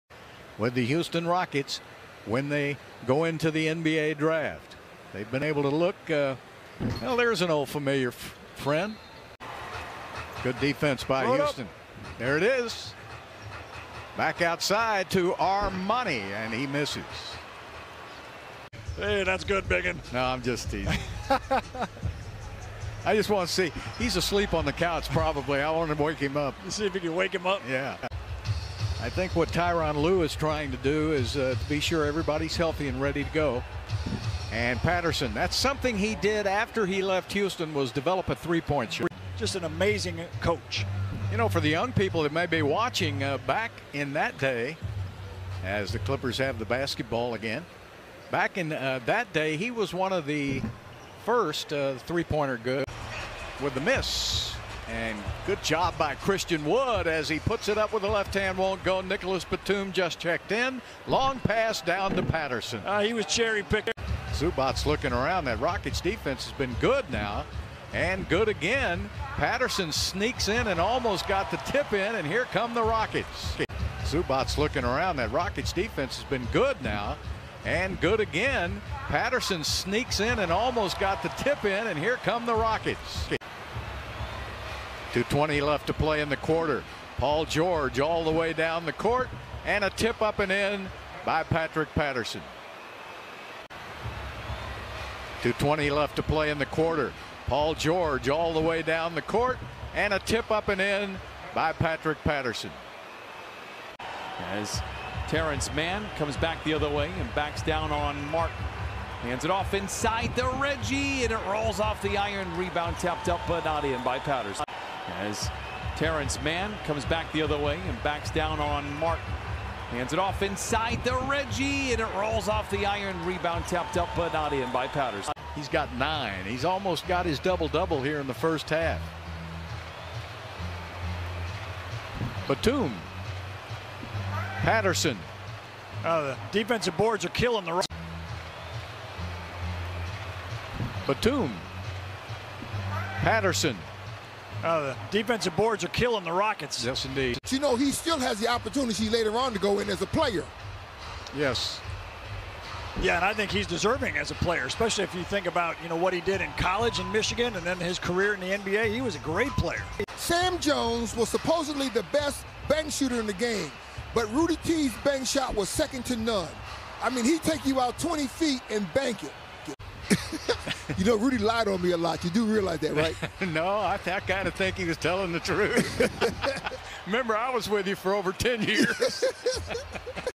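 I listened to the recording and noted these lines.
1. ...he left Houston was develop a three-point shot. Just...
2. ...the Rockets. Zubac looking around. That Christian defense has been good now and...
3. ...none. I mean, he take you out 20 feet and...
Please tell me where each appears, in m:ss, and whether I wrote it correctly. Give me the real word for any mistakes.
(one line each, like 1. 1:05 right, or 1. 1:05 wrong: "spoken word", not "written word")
1. 0:36 right
2. 1:12 wrong: "Rockets", not "Christian"
3. 2:46 right.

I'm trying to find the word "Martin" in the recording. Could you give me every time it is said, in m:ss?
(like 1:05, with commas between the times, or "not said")
1:48, 1:58.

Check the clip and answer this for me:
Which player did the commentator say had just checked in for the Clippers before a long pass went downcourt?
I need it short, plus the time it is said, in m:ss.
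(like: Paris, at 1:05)
Nicolas Batum, at 0:58.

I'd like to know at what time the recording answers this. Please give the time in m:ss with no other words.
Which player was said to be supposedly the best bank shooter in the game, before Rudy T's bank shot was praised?
2:40.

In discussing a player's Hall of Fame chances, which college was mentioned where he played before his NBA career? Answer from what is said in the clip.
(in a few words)
Michigan.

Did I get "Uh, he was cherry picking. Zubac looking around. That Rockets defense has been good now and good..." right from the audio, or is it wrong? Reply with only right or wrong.
right.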